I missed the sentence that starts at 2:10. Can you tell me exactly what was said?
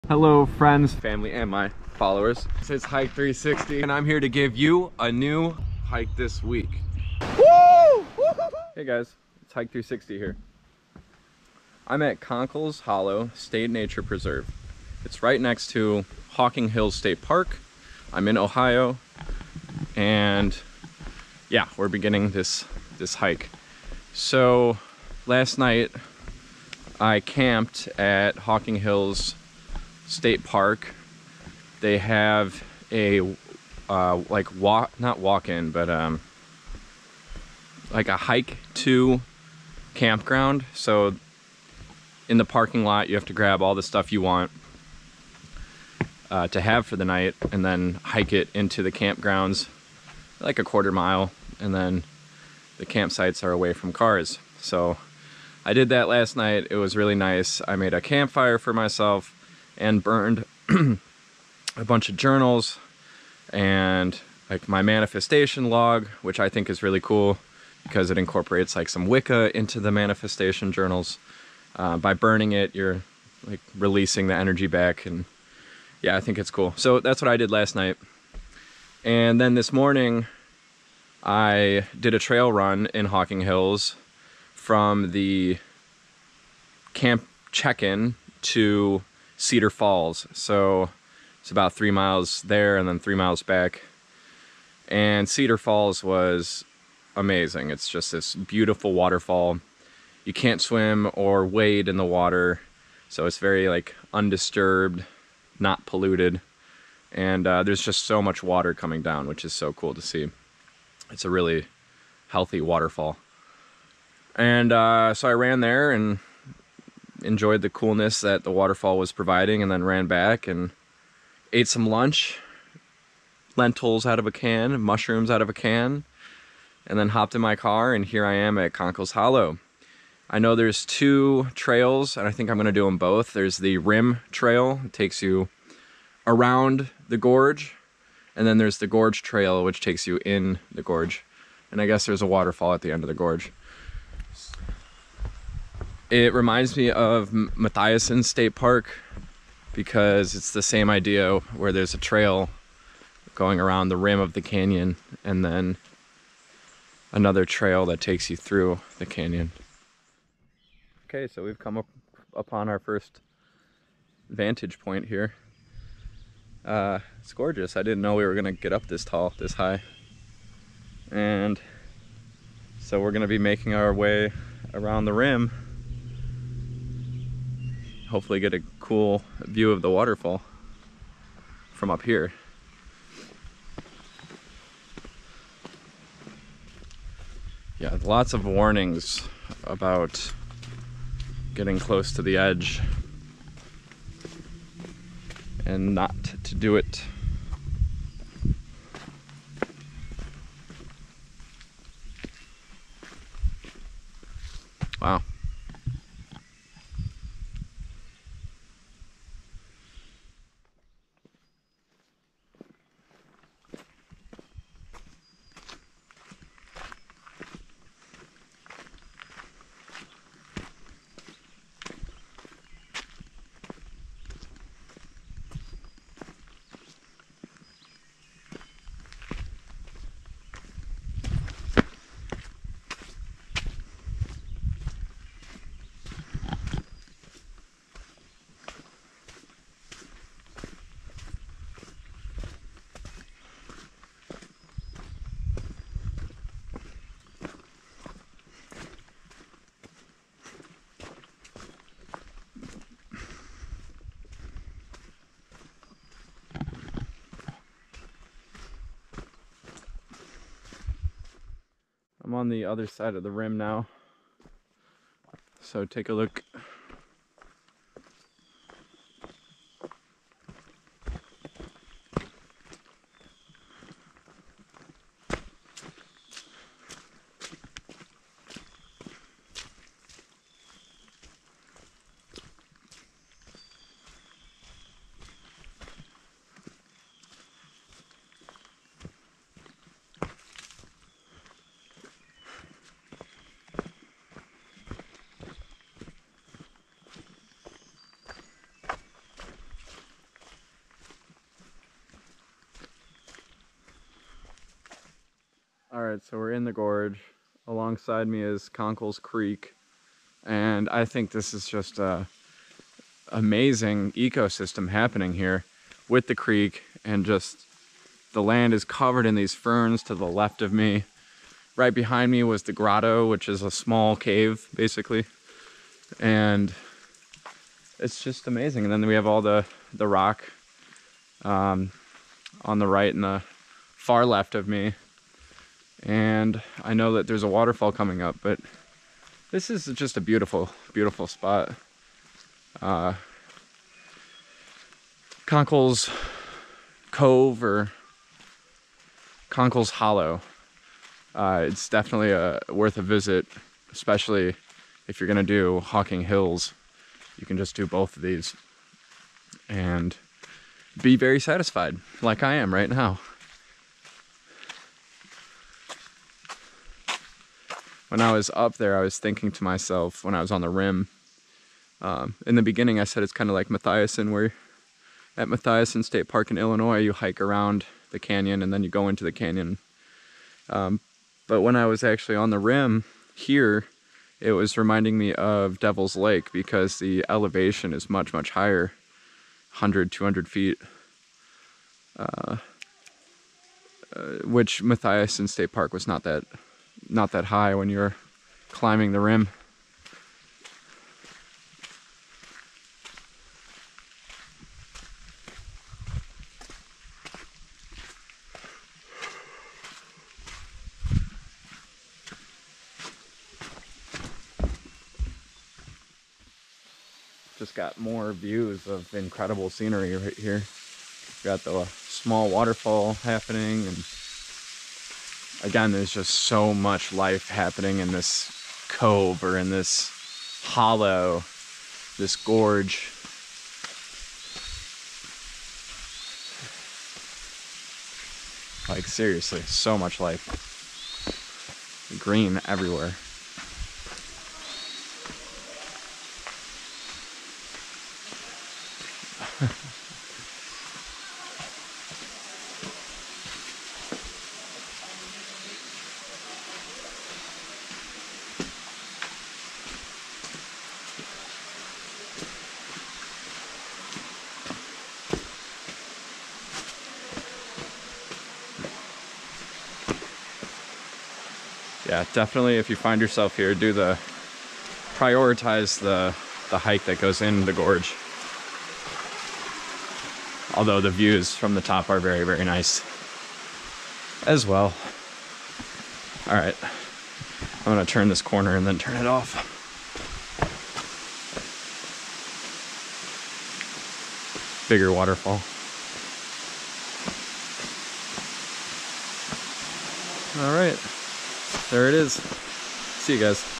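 I know there's two trails and I think I'm gonna do them both.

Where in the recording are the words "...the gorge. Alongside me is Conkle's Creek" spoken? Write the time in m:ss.
5:06.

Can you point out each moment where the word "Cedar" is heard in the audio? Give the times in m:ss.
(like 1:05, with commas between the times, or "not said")
1:29, 1:35.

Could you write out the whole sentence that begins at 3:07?
Yeah, lots of warnings about getting close to the edge and not to do it.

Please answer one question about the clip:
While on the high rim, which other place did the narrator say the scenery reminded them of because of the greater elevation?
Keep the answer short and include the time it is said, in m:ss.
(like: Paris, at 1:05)
Devil's Lake, at 6:25.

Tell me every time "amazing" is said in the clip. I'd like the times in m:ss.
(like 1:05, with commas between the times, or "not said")
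1:37, 5:13, 5:28.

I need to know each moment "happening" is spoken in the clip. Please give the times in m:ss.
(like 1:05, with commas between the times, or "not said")
5:14, 7:03, 7:07.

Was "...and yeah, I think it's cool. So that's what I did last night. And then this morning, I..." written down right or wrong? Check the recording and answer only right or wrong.
right.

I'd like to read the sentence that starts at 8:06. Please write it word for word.
All right, I'm gonna turn this corner and then turn it off.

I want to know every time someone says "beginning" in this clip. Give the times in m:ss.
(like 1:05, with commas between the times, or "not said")
0:21, 6:12.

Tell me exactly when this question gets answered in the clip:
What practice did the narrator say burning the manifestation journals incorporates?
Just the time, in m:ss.
1:09.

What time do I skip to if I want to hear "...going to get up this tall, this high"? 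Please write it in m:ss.
2:48.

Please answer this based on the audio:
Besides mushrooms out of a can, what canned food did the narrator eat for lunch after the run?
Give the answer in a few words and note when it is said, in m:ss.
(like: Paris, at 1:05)
lentils, at 2:03.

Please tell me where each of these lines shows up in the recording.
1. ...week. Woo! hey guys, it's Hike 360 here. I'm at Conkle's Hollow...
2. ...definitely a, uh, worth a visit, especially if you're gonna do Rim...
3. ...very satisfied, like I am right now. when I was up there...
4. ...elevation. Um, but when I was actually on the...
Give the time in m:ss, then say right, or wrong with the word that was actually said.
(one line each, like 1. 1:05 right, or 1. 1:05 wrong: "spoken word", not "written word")
1. 0:06 right
2. 5:51 wrong: "Hocking", not "Rim"
3. 6:01 right
4. 6:19 wrong: "canyon", not "elevation".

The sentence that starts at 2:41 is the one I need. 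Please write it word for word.
Okay, so we've come up upon our first vantage point here.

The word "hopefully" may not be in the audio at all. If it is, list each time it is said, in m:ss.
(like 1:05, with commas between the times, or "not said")
2:58.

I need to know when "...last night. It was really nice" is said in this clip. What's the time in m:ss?
0:56.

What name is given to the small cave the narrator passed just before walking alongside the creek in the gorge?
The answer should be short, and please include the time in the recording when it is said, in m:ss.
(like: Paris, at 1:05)
the grotto, at 5:22.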